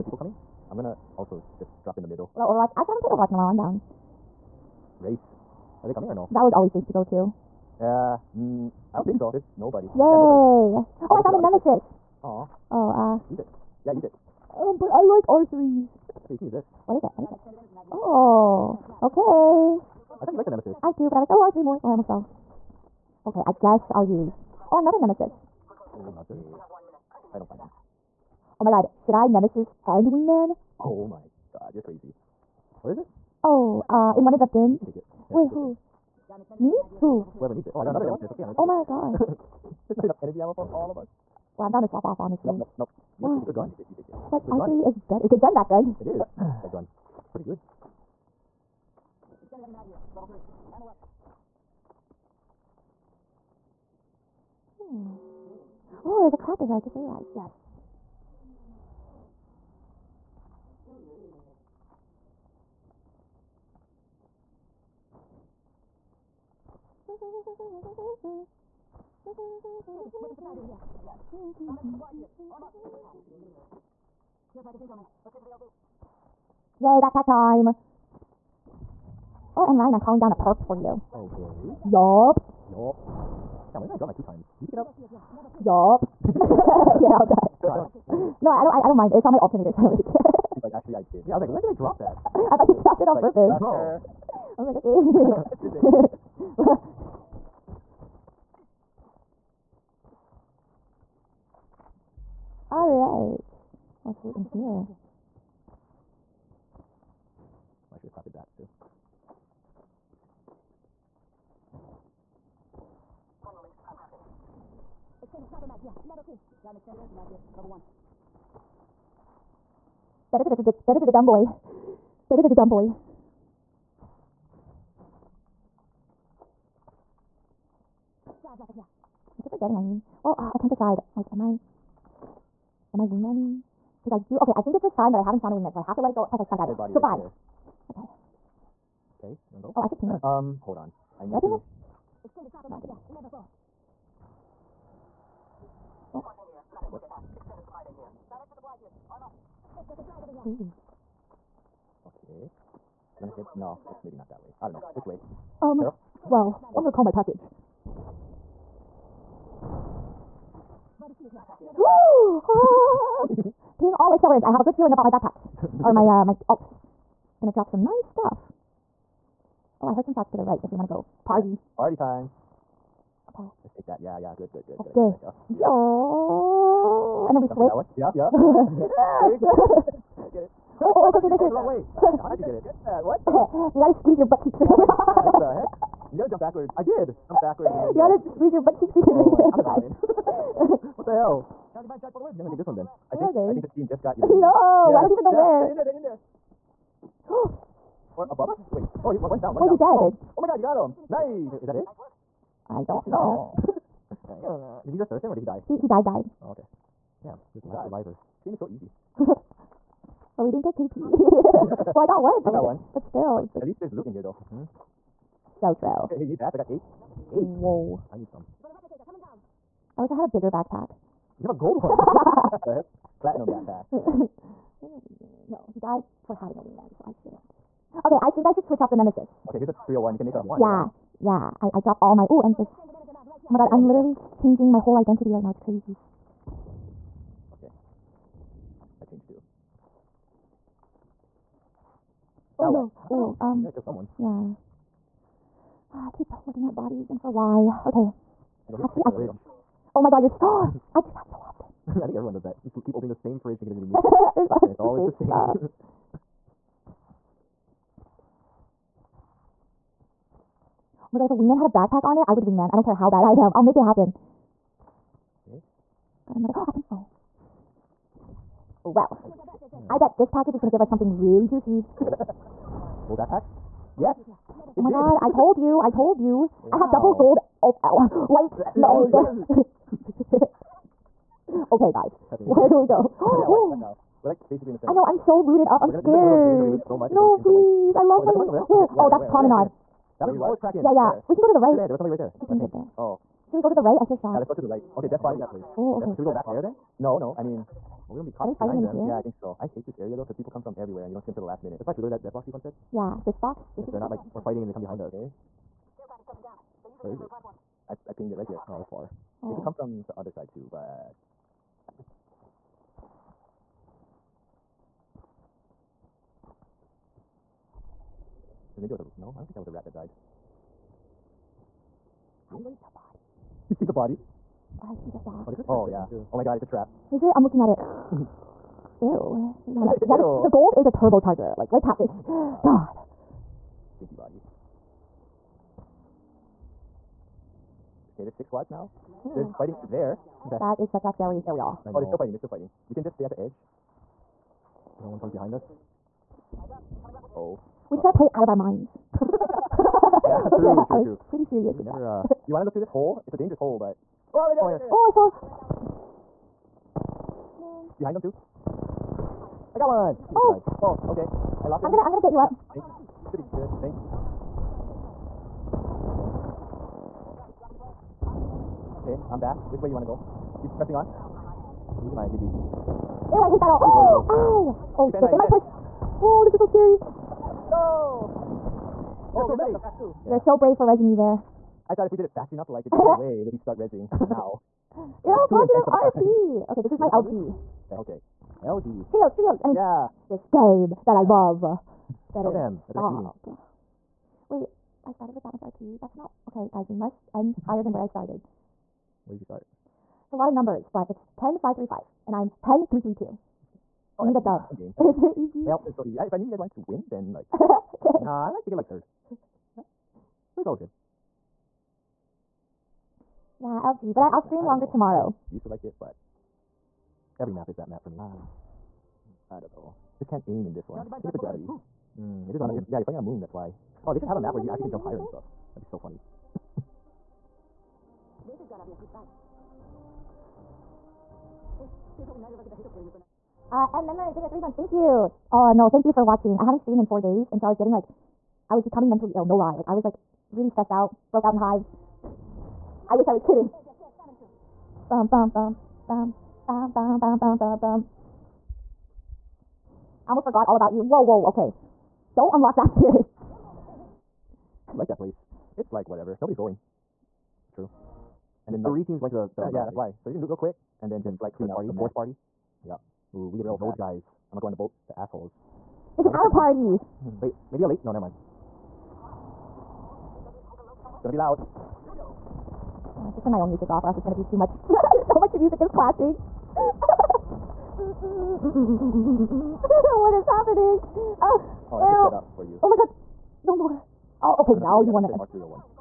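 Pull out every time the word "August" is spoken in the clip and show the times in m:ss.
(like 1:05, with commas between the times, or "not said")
not said.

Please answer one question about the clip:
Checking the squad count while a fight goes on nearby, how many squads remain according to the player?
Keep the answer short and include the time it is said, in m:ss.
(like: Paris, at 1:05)
6, at 5:38.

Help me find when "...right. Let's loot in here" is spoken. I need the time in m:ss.
1:42.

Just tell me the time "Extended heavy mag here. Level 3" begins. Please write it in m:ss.
0:49.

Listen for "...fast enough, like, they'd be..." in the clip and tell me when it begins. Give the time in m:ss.
6:22.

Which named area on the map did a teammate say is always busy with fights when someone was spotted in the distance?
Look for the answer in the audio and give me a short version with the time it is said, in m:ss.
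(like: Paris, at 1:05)
Promenade, at 4:49.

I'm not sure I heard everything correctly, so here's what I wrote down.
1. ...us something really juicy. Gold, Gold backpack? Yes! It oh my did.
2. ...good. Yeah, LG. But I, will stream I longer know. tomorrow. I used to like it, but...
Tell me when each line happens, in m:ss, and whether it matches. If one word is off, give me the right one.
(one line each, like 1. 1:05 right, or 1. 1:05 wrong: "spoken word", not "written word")
1. 4:30 right
2. 6:50 right.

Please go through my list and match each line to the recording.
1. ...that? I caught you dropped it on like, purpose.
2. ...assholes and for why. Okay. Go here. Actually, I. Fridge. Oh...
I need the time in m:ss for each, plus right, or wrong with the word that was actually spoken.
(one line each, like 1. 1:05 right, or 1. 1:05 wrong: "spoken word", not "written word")
1. 1:31 wrong: "thought", not "caught"
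2. 4:06 wrong: "bodies", not "assholes".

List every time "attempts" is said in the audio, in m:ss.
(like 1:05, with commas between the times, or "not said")
not said.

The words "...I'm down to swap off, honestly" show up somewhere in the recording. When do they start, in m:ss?
0:41.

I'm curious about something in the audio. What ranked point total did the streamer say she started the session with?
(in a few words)
10535.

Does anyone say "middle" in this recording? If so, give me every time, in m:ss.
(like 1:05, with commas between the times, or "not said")
0:02.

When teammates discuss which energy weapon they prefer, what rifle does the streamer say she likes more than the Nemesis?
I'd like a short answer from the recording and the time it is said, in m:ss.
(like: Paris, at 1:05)
R3, at 0:15.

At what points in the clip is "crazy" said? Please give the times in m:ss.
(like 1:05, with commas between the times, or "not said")
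0:31, 3:55.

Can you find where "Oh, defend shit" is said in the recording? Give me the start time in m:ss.
6:14.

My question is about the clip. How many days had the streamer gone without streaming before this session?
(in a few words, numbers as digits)
4.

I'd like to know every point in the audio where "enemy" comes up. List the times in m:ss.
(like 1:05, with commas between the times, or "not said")
not said.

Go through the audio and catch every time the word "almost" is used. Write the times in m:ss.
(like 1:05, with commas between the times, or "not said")
0:21, 7:30.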